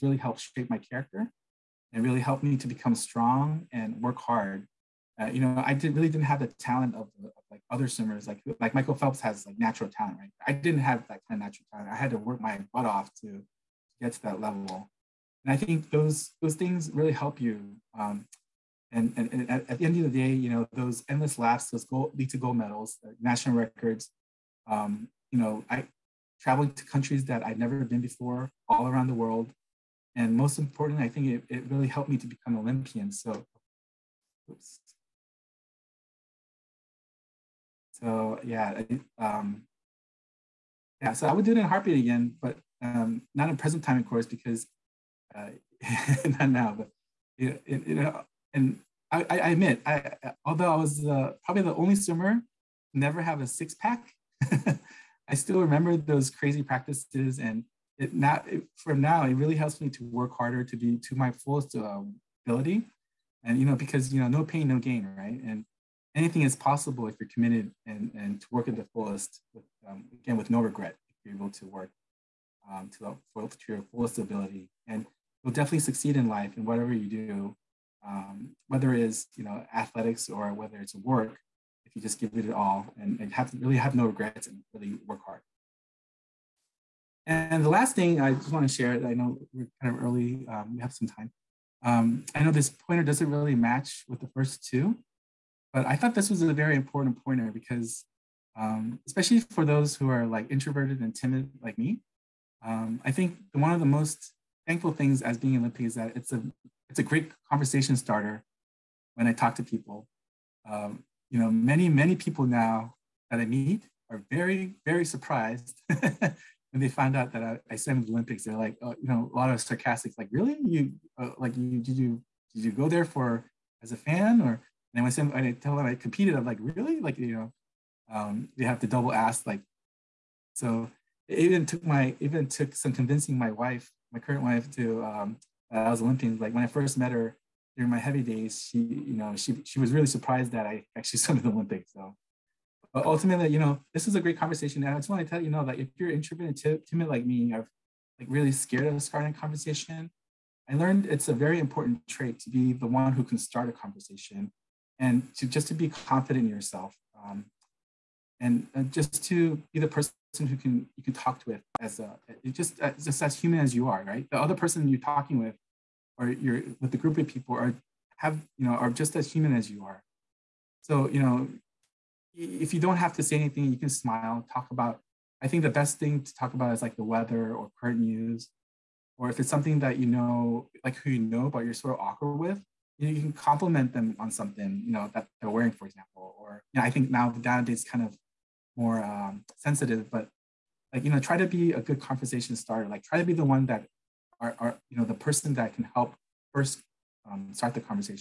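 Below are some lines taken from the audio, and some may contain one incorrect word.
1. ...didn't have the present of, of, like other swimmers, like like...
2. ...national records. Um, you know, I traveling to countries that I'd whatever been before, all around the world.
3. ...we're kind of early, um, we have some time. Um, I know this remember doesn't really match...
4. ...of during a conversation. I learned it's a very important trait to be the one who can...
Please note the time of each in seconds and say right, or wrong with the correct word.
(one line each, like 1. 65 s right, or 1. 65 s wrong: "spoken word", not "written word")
1. 6 s wrong: "talent", not "present"
2. 23 s wrong: "never", not "whatever"
3. 89 s wrong: "pointer", not "remember"
4. 148 s wrong: "starting", not "during".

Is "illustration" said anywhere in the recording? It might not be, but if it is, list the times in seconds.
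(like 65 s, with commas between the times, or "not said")
not said.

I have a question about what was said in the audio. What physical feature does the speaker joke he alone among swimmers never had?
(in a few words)
A six pack.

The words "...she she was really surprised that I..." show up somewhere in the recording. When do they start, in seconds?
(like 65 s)
139 s.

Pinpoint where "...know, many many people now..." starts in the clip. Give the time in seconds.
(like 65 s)
111 s.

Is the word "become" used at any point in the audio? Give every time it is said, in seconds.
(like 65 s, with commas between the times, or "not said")
2 s, 32 s.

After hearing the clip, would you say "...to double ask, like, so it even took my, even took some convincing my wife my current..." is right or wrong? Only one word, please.
right.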